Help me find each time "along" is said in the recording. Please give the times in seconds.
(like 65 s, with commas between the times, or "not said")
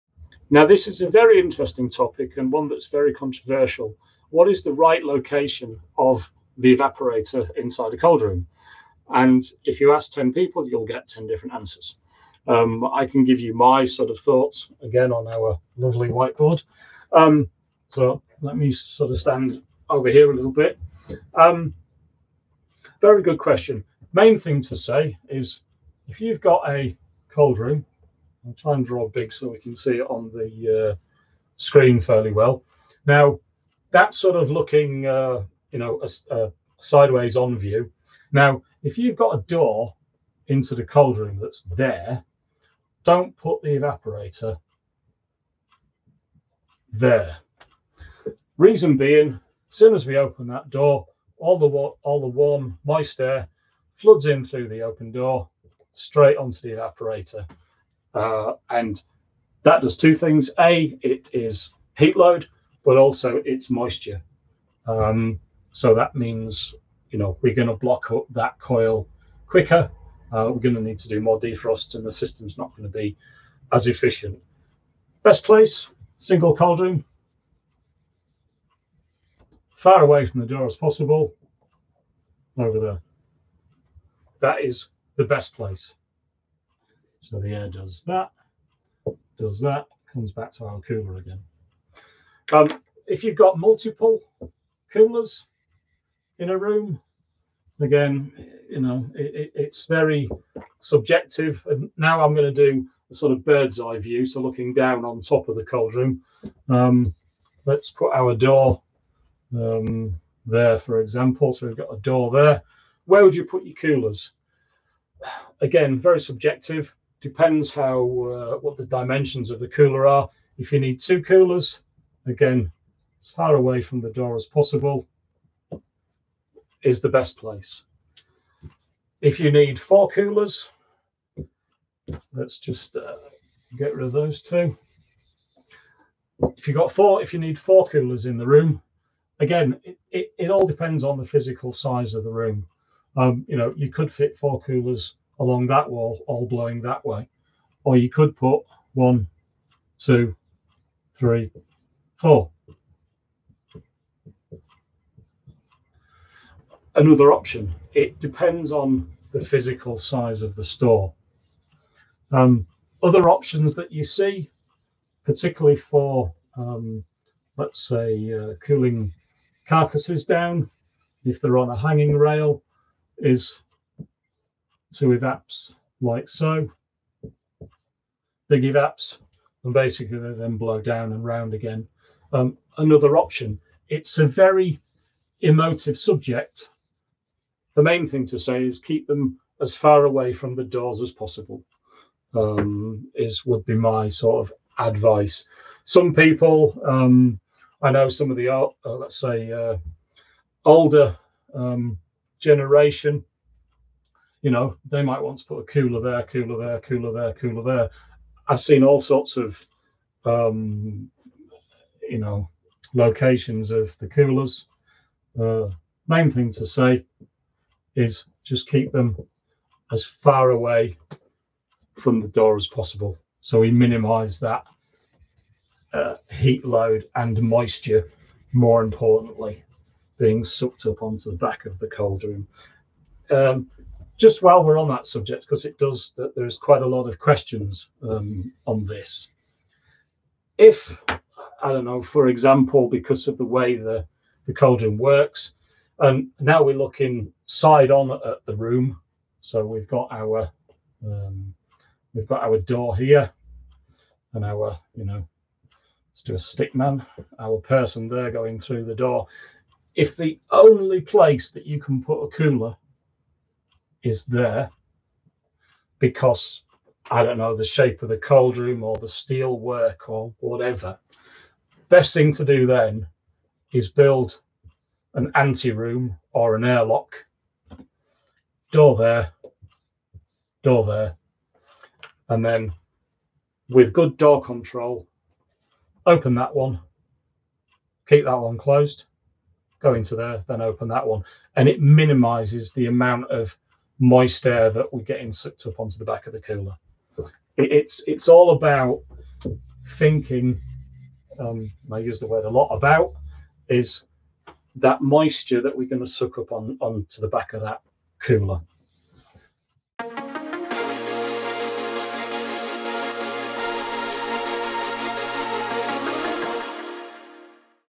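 145 s.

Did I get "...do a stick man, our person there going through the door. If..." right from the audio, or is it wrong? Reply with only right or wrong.
right.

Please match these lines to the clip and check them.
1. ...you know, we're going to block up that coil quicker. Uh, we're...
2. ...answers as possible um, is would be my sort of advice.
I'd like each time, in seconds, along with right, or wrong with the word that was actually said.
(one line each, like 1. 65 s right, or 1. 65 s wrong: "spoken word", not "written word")
1. 67 s right
2. 190 s wrong: "doors", not "answers".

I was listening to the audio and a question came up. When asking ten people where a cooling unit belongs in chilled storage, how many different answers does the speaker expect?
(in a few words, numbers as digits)
10.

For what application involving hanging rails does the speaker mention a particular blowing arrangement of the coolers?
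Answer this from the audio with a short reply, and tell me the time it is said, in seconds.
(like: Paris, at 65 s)
Cooling carcasses, at 168 s.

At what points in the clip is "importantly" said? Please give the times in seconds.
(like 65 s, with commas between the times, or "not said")
228 s.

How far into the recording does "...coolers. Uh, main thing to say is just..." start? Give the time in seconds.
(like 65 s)
214 s.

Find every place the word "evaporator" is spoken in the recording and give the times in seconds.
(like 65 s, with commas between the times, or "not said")
6 s, 43 s, 56 s.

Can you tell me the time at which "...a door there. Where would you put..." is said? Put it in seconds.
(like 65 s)
111 s.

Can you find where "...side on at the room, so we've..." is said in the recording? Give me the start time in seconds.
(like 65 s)
247 s.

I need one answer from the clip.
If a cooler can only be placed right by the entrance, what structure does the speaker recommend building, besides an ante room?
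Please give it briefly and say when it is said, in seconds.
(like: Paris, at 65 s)
An airlock, at 276 s.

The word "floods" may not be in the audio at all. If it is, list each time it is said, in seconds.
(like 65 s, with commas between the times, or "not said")
53 s.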